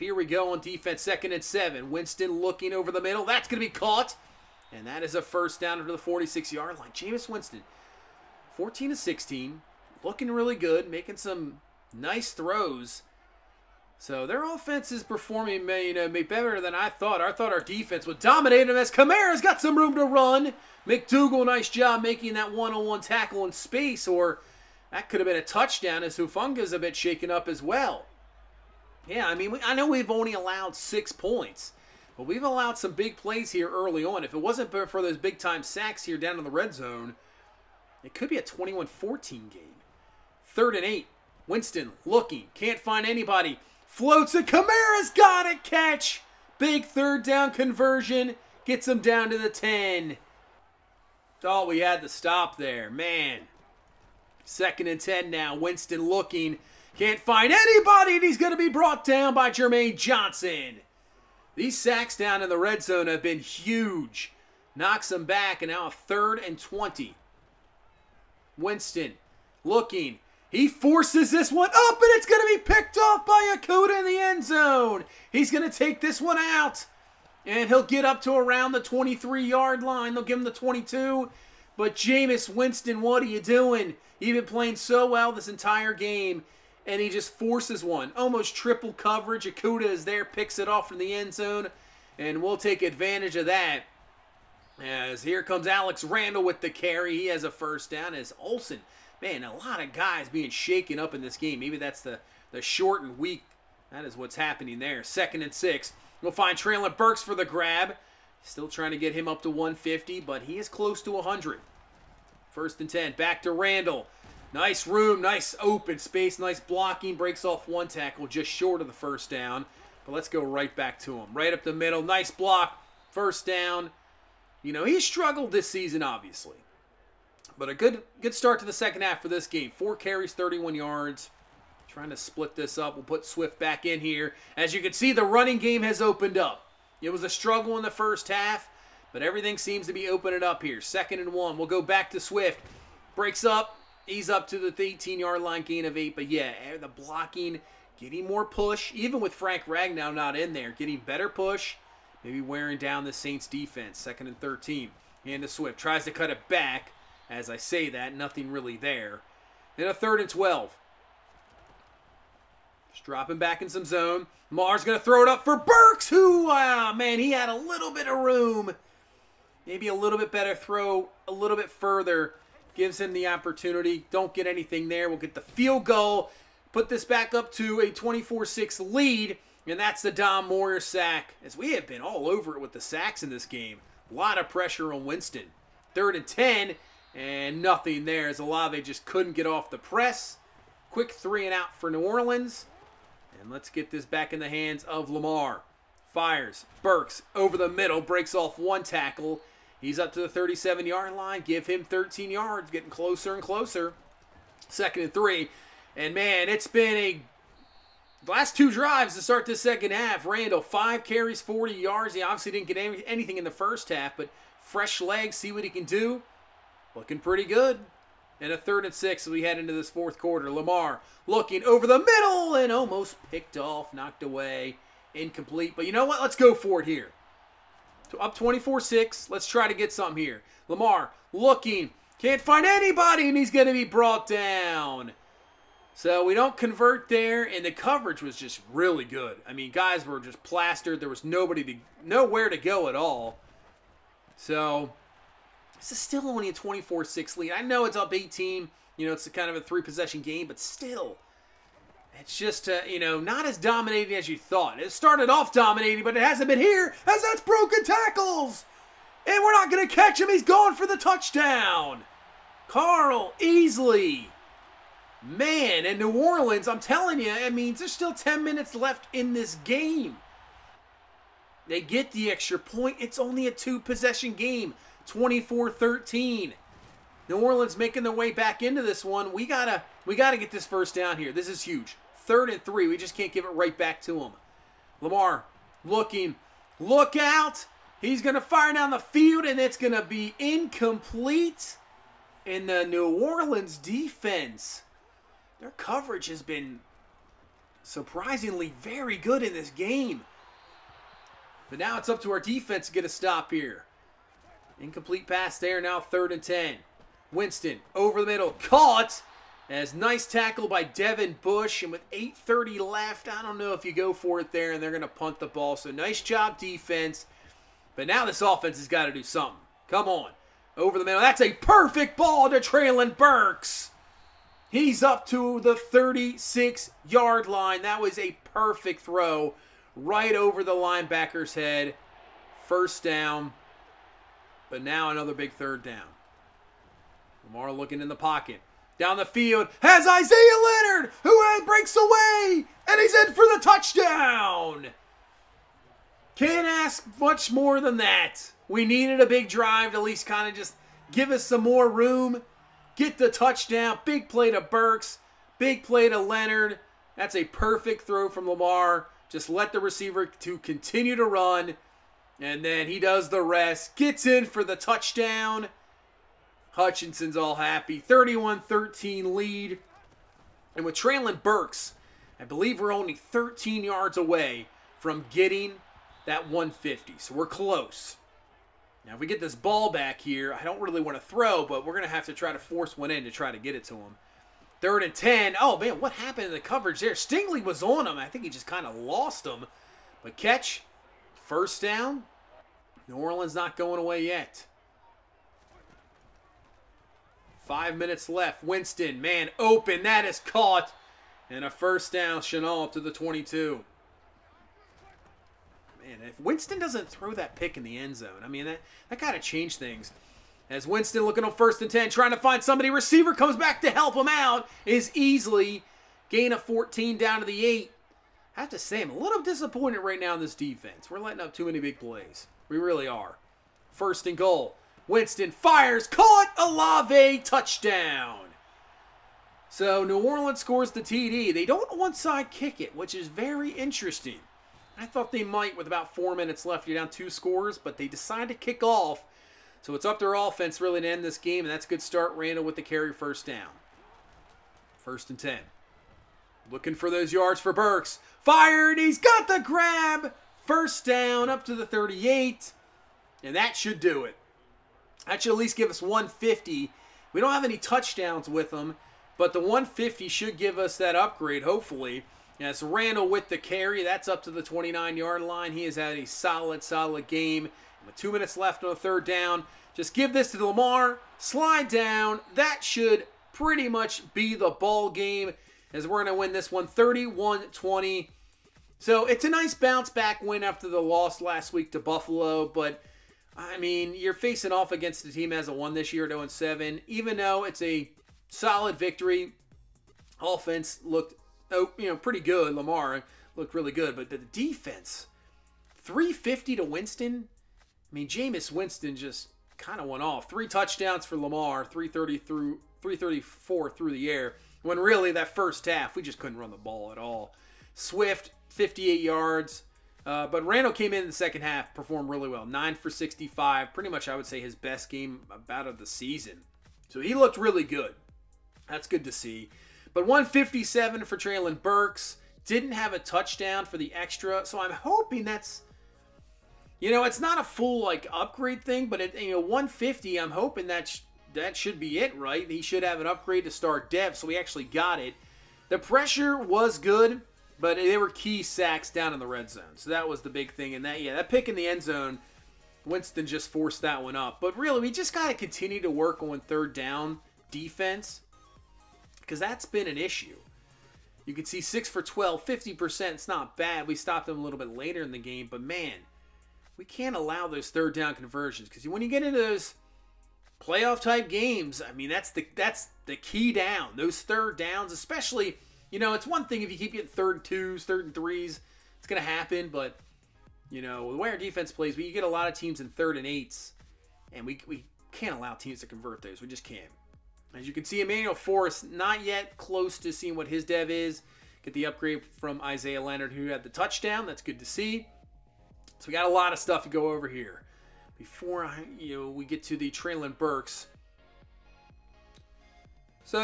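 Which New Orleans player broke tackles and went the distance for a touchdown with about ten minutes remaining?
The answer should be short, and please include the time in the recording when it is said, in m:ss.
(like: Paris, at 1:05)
Carl Easley, at 4:22.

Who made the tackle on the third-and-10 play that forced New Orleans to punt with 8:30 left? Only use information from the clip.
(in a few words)
Devin Bush.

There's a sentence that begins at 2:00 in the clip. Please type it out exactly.
But let's go right back to him.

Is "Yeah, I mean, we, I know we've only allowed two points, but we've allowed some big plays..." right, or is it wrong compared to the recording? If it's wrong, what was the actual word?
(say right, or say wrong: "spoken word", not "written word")
wrong: "six", not "two".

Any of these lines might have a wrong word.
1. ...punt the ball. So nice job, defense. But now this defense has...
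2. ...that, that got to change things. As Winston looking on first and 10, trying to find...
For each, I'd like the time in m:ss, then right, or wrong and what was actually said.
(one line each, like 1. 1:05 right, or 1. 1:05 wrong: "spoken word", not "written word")
1. 5:15 wrong: "offense", not "defense"
2. 6:48 right.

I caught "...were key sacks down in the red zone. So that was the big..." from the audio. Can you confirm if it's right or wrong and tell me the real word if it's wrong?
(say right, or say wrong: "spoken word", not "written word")
right.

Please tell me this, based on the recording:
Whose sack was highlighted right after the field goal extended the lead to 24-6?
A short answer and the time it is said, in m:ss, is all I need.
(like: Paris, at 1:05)
Dom Moyer, at 3:00.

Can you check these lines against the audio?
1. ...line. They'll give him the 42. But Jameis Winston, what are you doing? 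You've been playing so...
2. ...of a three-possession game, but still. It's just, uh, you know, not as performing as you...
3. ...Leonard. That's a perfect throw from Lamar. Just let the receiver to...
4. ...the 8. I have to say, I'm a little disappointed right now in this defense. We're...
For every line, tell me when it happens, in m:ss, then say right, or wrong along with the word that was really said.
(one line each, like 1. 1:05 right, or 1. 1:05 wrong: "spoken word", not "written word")
1. 1:19 wrong: "22", not "42"
2. 4:09 wrong: "dominating", not "performing"
3. 5:56 right
4. 6:57 right.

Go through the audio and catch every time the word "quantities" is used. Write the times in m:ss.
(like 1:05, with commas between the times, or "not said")
not said.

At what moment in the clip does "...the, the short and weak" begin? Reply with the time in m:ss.
1:42.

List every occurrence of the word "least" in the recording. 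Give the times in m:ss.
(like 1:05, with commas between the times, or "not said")
5:50, 7:35.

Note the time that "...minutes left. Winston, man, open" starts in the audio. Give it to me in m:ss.
6:37.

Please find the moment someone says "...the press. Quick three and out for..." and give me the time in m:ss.
3:09.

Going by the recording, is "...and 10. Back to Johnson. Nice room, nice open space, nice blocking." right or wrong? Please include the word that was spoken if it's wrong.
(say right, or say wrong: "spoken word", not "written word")
wrong: "Randall", not "Johnson".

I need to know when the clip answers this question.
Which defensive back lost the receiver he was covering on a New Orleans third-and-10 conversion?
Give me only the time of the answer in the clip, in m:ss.
6:27.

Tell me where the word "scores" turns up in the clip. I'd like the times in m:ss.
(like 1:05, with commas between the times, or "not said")
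7:10, 7:17.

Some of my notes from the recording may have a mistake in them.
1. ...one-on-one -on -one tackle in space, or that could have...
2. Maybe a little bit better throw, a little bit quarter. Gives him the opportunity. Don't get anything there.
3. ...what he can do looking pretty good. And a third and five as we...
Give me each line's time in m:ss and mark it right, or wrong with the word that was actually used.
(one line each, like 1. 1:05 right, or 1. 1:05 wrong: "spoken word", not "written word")
1. 0:22 right
2. 2:49 wrong: "further", not "quarter"
3. 3:35 wrong: "six", not "five".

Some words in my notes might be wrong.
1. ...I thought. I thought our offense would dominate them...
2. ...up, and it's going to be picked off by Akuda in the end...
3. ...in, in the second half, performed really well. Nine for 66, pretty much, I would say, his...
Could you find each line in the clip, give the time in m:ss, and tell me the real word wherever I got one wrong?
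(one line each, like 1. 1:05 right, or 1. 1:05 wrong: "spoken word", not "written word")
1. 0:16 wrong: "defense", not "offense"
2. 1:11 right
3. 8:31 wrong: "65", not "66".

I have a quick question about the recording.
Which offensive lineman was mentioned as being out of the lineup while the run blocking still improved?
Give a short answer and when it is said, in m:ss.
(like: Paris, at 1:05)
Frank Ragnow, at 2:29.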